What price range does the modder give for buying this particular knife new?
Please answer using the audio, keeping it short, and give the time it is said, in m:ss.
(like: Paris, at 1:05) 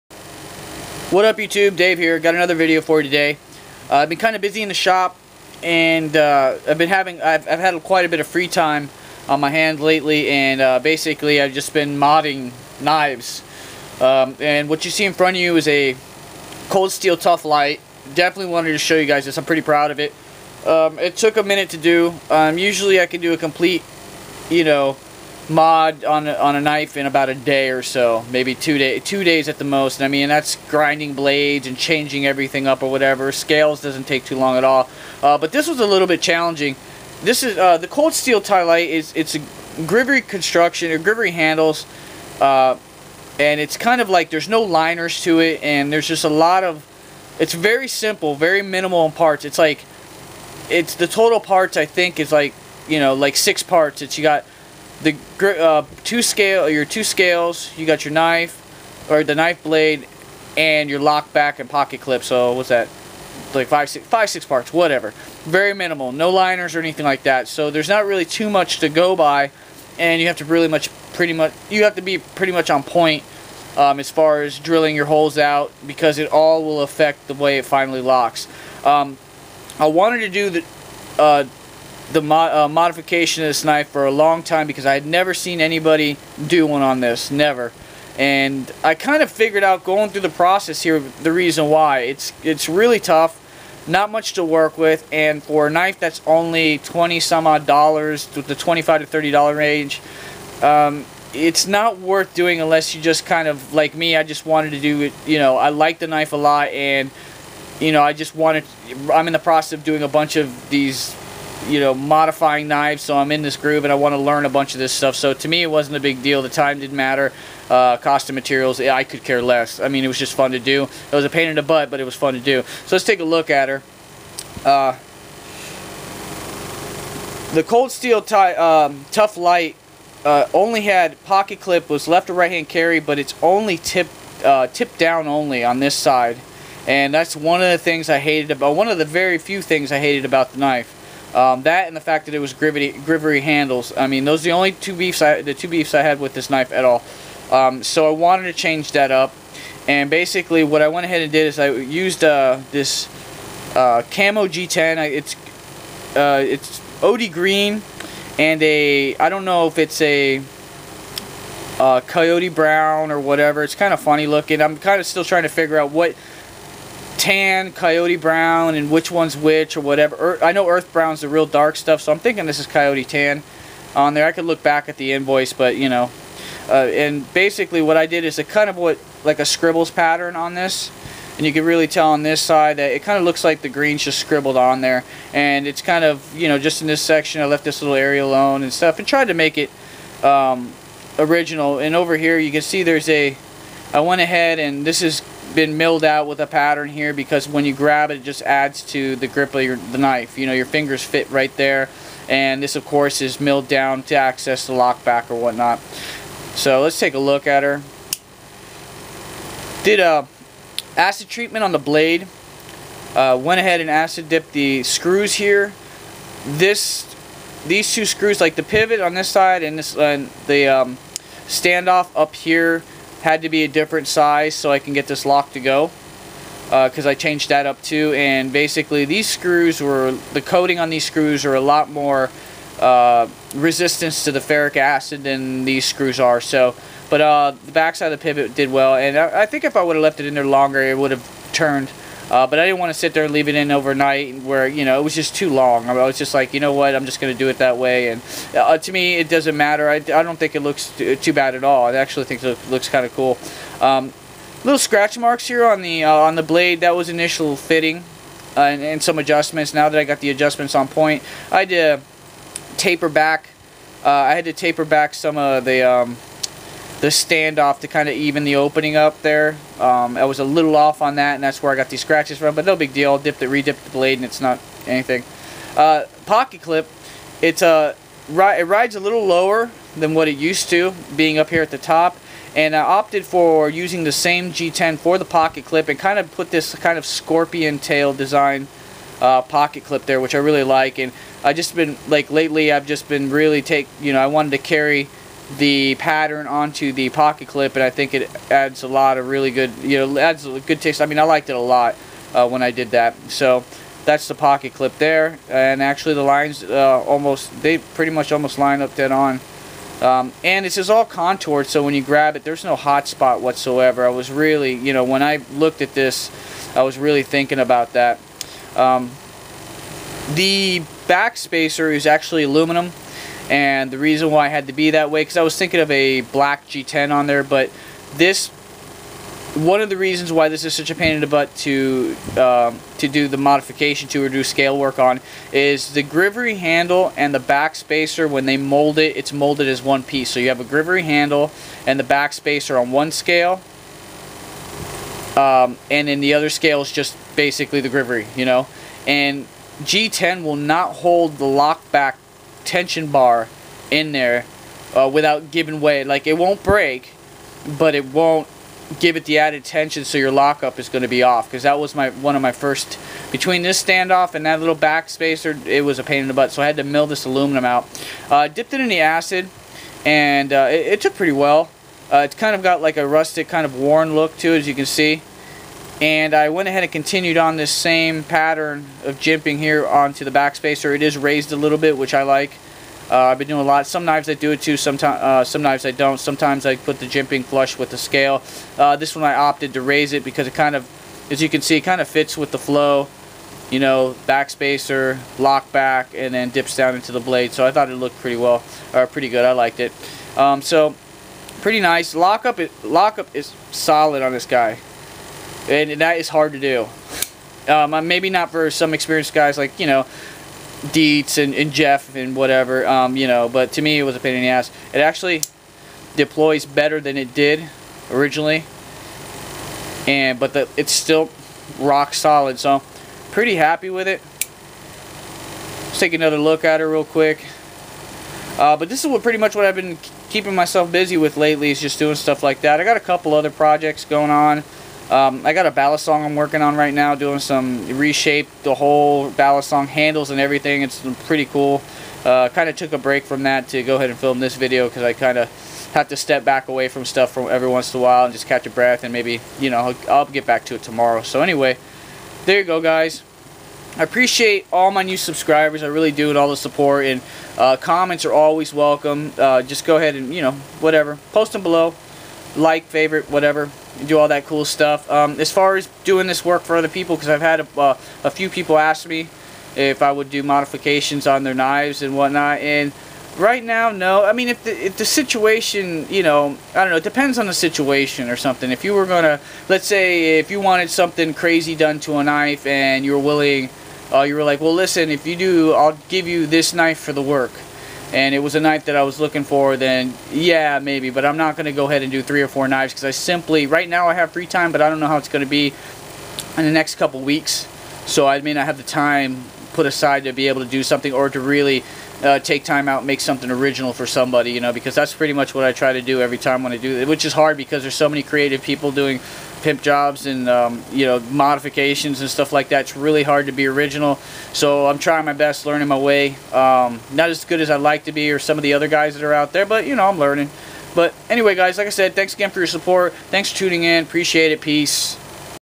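$25 to $30, at 1:38.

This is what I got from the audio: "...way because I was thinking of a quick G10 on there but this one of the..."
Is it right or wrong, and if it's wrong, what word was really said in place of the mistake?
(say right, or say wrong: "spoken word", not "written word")
wrong: "black", not "quick".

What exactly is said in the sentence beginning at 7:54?
I mean, if the, if the situation, you know, I don't know, it depends on the situation or something.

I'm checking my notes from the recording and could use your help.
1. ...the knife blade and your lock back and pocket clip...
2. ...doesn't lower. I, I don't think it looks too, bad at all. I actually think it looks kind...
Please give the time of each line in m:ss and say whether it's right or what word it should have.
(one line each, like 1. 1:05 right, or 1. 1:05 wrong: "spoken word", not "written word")
1. 0:59 right
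2. 4:09 wrong: "matter", not "lower".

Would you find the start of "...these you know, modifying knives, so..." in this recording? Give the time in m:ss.
1:50.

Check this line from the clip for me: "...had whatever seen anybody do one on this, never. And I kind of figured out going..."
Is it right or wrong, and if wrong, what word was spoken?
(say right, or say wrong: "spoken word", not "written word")
wrong: "never", not "whatever".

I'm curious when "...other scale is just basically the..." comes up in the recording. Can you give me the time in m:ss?
5:46.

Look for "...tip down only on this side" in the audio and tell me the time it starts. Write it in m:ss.
2:14.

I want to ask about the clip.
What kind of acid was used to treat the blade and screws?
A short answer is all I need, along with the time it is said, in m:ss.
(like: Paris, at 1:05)
Ferric acid, at 3:54.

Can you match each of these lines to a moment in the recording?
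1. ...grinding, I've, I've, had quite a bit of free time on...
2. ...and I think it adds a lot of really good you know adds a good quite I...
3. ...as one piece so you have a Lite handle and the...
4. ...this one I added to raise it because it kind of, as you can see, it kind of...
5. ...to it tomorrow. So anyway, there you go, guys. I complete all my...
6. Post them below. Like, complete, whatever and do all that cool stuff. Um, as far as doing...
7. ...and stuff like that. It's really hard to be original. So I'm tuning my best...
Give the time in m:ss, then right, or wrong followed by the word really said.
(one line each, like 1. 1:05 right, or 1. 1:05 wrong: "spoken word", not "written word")
1. 0:06 wrong: "having", not "grinding"
2. 4:57 wrong: "taste", not "quite"
3. 5:39 wrong: "Grivory", not "Lite"
4. 6:28 wrong: "opted", not "added"
5. 7:30 wrong: "appreciate", not "complete"
6. 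7:41 wrong: "favorite", not "complete"
7. 8:32 wrong: "trying", not "tuning".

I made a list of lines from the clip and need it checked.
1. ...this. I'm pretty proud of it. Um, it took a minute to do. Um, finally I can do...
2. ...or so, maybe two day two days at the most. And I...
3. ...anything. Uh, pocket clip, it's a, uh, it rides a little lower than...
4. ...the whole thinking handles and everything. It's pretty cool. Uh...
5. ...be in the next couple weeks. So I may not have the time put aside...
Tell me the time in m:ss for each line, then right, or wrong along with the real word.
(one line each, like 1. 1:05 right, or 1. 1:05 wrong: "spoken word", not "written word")
1. 0:19 wrong: "usually", not "finally"
2. 0:27 right
3. 4:34 right
4. 7:18 wrong: "balisong", not "thinking"
5. 8:15 right.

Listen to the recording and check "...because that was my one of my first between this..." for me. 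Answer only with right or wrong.
right.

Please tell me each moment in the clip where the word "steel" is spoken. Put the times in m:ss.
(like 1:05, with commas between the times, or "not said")
0:16, 0:38, 2:07.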